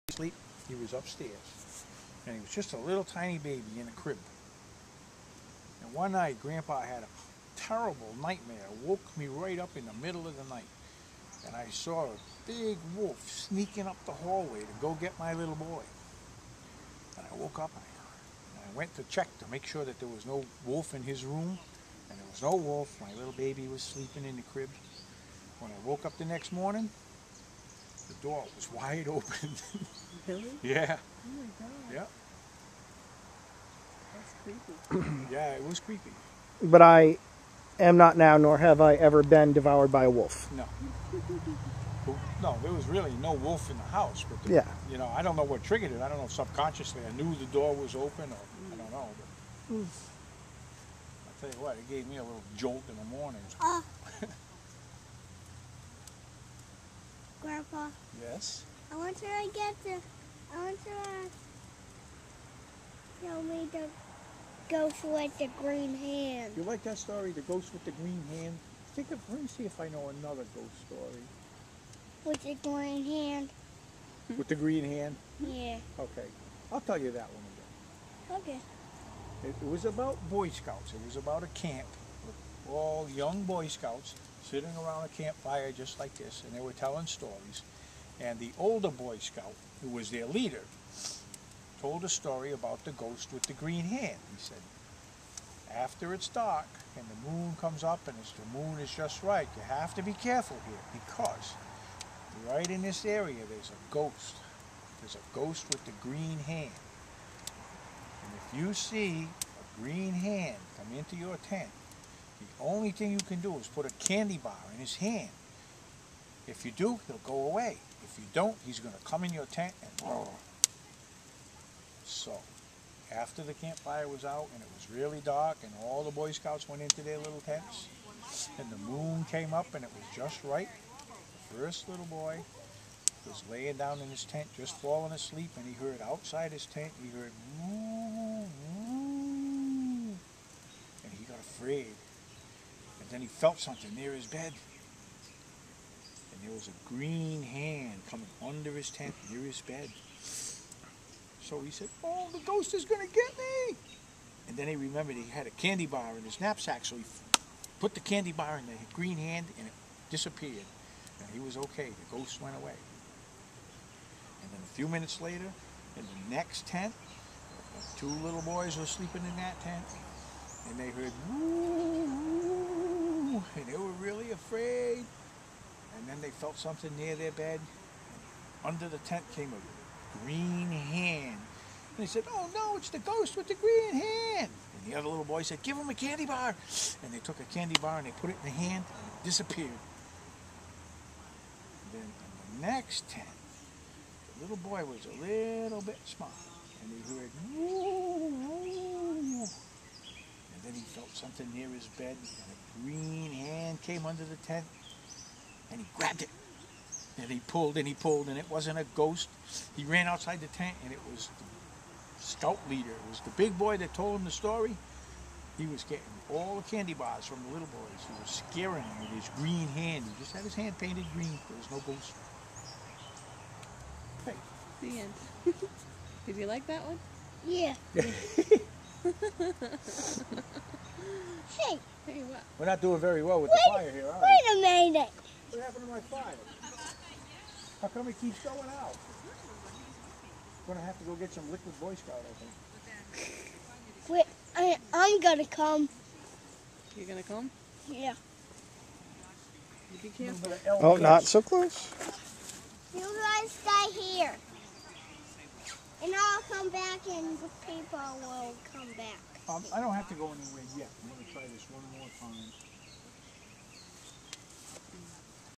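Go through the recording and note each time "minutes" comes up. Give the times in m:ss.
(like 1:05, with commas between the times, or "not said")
2:44, 3:54.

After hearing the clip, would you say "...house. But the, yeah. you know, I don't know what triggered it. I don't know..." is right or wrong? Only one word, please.
right.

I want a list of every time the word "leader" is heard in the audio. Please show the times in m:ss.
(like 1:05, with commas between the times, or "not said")
1:30, 3:32.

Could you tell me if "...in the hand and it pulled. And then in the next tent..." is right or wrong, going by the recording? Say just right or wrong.
wrong.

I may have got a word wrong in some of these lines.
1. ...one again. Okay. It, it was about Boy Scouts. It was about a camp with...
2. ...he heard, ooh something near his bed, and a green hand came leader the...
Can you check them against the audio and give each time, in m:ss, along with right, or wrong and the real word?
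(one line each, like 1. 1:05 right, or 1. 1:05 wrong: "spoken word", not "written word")
1. 1:17 right
2. 3:16 wrong: "under", not "leader".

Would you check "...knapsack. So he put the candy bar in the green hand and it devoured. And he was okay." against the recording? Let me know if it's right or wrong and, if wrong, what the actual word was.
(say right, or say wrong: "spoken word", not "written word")
wrong: "disappeared", not "devoured".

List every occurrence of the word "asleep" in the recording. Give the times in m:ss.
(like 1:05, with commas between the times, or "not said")
0:00, 2:15.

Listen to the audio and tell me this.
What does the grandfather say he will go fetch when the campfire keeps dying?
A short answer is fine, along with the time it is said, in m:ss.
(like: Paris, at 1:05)
Liquid Boy Scout, at 4:01.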